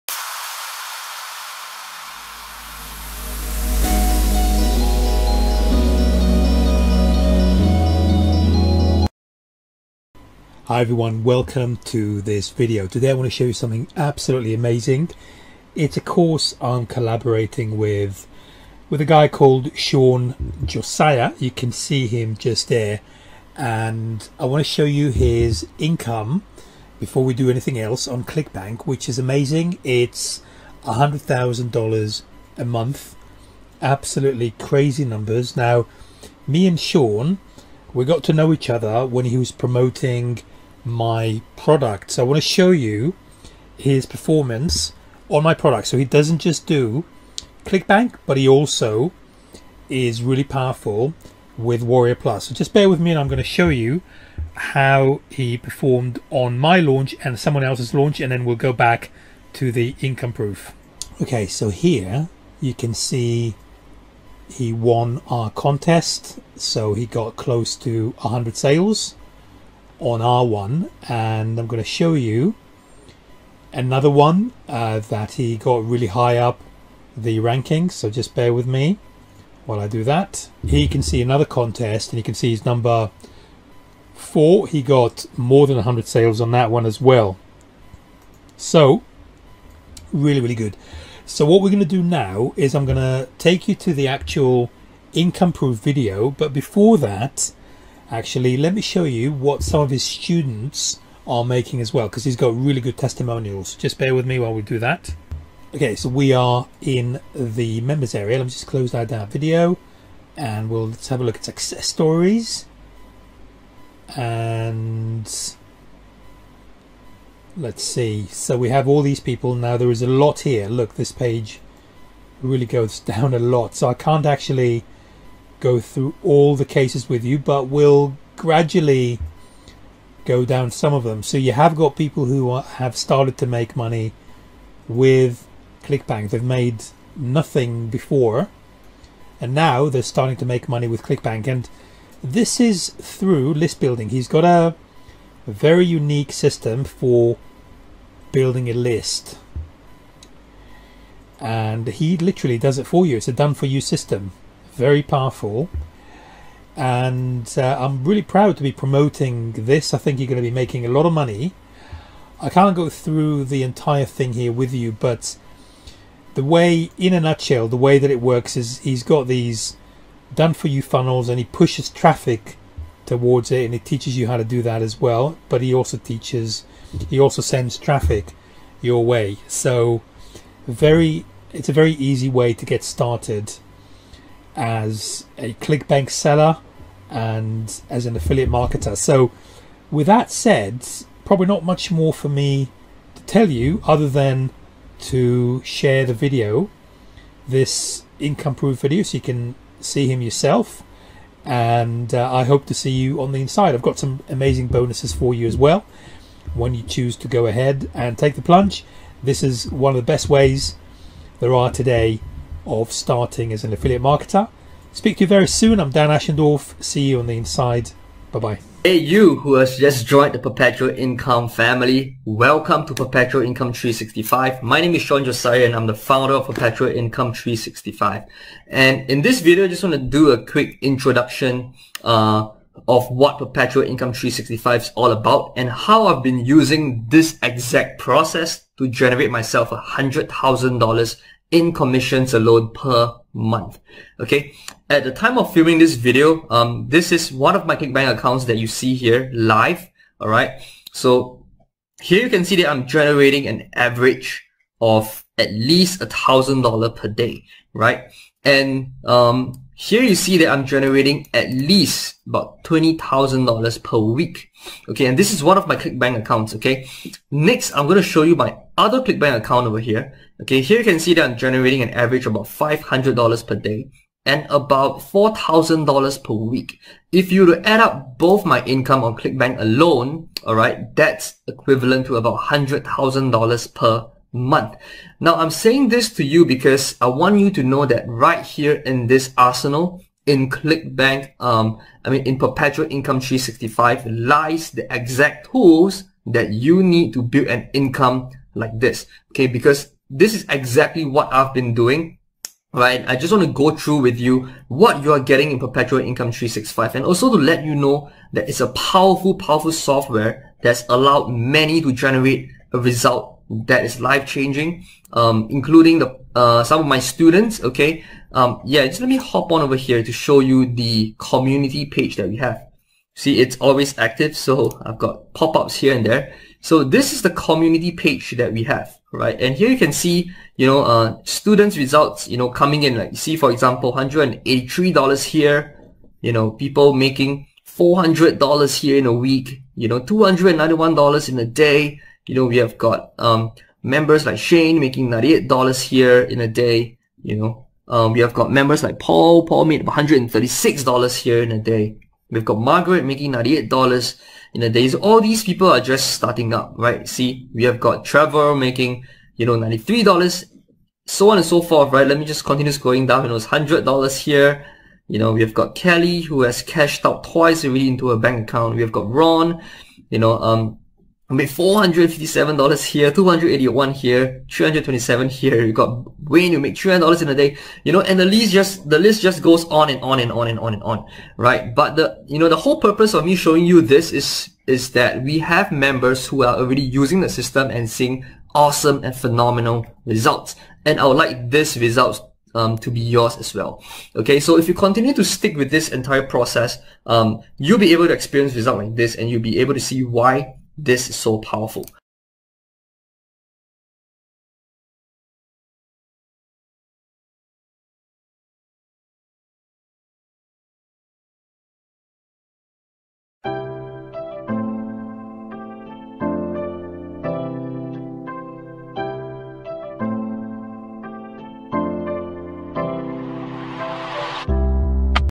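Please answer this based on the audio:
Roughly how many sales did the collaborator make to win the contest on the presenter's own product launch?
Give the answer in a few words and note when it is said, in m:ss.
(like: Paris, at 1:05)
close to 100, at 1:07.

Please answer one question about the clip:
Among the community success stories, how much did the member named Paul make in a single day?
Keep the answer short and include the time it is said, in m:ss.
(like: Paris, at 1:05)
$136, at 5:49.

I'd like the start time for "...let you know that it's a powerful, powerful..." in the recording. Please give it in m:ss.
5:07.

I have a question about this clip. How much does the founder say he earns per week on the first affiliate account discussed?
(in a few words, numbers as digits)
$20,000.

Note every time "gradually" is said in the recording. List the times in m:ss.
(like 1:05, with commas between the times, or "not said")
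2:08.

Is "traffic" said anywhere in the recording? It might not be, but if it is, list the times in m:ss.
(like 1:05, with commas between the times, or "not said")
2:51, 2:57.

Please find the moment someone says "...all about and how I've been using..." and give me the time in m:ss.
3:54.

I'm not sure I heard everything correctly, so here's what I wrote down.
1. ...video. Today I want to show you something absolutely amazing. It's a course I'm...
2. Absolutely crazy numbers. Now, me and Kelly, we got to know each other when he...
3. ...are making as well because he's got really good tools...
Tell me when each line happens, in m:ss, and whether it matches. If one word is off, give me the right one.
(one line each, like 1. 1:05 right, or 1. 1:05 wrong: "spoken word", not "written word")
1. 0:12 right
2. 0:33 wrong: "Shawn", not "Kelly"
3. 1:41 wrong: "testimonials", not "tools".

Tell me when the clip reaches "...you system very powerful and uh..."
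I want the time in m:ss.
2:33.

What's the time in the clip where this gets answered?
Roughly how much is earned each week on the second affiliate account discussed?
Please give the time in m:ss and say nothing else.
4:34.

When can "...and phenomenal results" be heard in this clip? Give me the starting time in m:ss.
6:29.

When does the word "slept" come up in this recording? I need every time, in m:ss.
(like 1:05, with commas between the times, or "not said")
not said.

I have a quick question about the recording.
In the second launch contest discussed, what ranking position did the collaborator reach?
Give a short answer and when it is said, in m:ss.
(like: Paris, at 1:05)
4, at 1:22.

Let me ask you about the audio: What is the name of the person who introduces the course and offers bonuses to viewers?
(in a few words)
Dan Ashendorf.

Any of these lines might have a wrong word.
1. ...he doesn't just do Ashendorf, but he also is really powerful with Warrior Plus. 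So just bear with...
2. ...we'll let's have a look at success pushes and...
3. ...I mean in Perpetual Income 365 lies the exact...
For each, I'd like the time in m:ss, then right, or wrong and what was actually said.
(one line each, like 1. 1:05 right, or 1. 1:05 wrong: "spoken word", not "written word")
1. 0:45 wrong: "ClickBank", not "Ashendorf"
2. 1:50 wrong: "stories", not "pushes"
3. 4:52 right.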